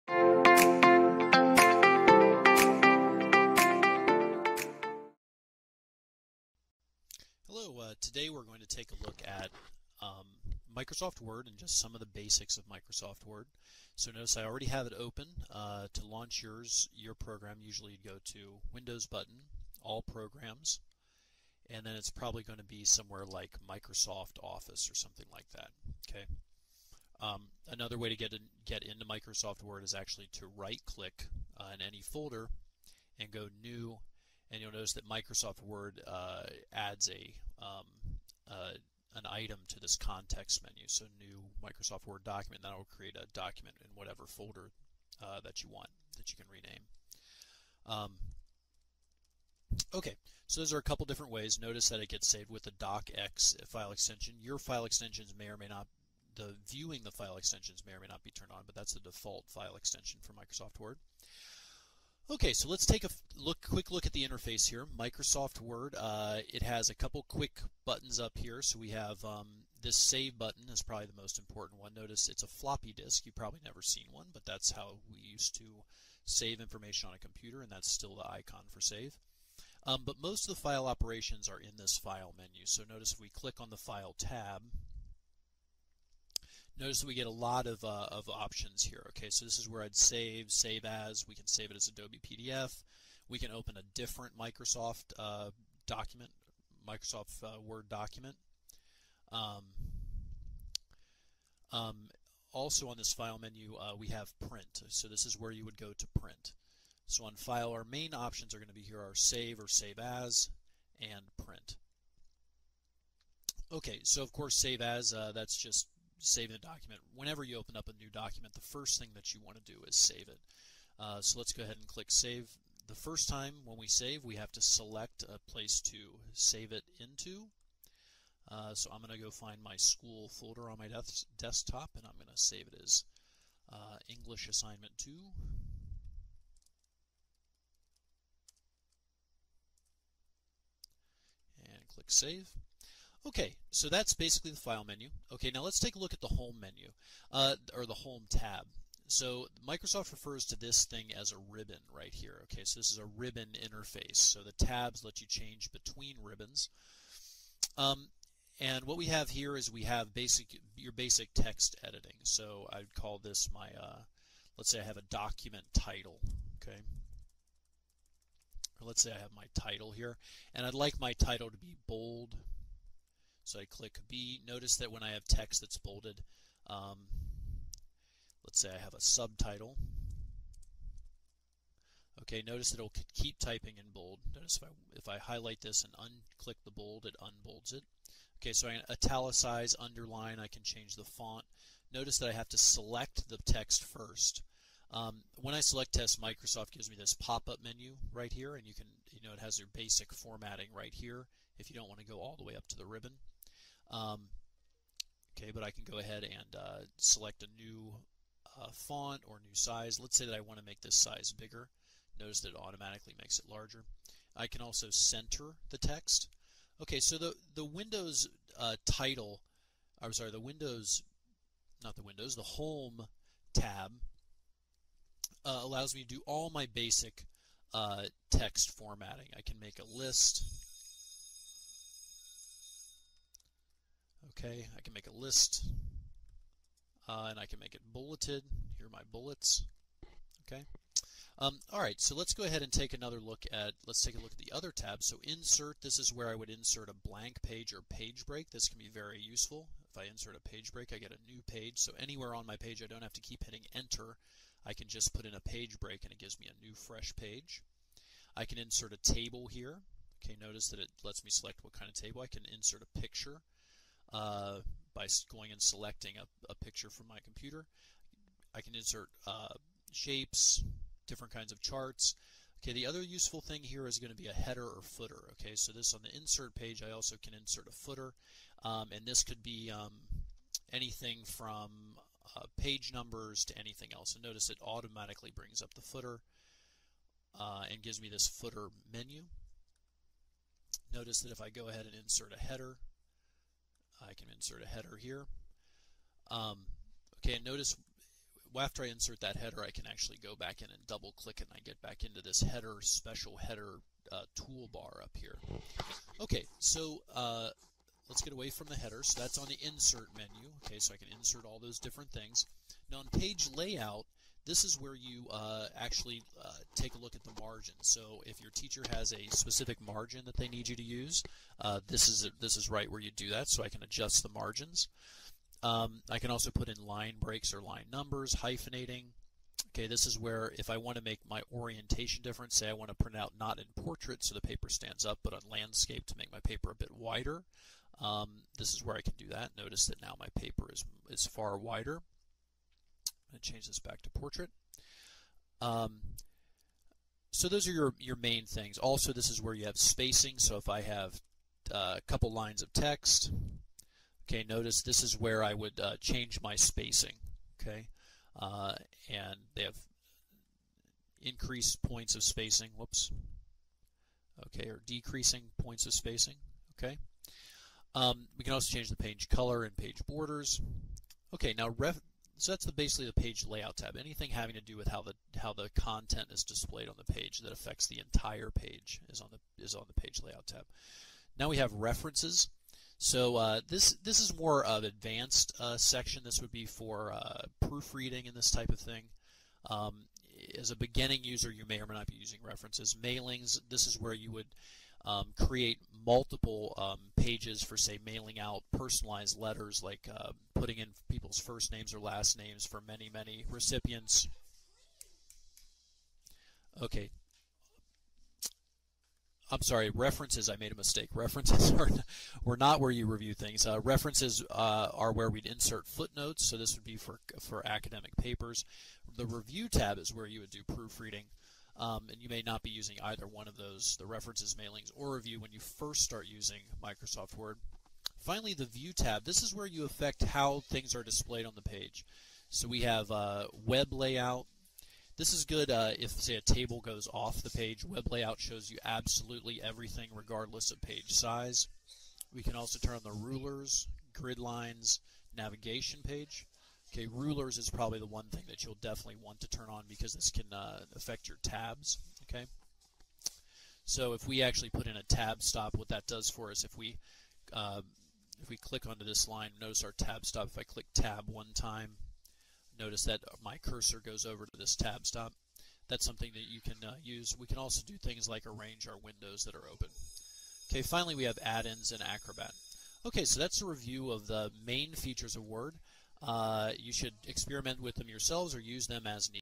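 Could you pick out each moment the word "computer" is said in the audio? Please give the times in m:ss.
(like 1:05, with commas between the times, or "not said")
1:17, 4:27.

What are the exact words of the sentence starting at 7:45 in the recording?
That's something that you can uh, use.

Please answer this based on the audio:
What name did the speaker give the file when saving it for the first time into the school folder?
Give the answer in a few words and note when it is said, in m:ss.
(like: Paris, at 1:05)
English Assignment 2, at 2:14.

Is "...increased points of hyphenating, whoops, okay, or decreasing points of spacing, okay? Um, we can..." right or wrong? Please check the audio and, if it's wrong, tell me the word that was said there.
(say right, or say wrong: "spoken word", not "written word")
wrong: "spacing", not "hyphenating".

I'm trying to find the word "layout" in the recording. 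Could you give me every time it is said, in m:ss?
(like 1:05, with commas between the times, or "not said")
5:13, 6:13, 6:20, 7:13, 7:18.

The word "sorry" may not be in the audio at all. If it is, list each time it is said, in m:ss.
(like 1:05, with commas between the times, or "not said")
3:40, 6:49.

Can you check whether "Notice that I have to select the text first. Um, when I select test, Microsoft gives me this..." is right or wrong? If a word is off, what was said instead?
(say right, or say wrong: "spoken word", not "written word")
right.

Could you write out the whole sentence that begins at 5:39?
Notice that now my paper is, is far wider.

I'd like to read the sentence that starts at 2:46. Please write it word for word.
Okay, or let's say I have my title here, and I'd like my title to be bold so I click B.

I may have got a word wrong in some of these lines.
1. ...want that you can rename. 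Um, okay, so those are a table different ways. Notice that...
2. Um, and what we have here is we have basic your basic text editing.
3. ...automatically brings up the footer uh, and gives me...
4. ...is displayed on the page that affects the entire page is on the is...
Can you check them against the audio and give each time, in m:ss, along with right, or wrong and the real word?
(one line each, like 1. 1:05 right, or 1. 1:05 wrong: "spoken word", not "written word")
1. 0:45 wrong: "couple", not "table"
2. 2:37 right
3. 4:44 right
4. 6:16 right.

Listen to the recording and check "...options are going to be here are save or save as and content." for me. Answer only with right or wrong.
wrong.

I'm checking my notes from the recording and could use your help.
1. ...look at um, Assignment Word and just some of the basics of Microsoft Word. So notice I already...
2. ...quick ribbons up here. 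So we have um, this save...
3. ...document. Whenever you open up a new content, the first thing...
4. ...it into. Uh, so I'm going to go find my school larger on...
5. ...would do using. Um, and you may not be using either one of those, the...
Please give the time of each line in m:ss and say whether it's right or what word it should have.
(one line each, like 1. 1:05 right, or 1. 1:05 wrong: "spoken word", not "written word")
1. 0:09 wrong: "Microsoft", not "Assignment"
2. 1:07 wrong: "buttons", not "ribbons"
3. 1:56 wrong: "document", not "content"
4. 2:06 wrong: "folder", not "larger"
5. 7:00 wrong: "proofreading", not "using".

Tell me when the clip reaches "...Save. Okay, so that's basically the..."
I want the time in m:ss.
2:22.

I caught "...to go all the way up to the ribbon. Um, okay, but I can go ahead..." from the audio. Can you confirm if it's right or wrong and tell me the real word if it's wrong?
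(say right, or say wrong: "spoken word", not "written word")
right.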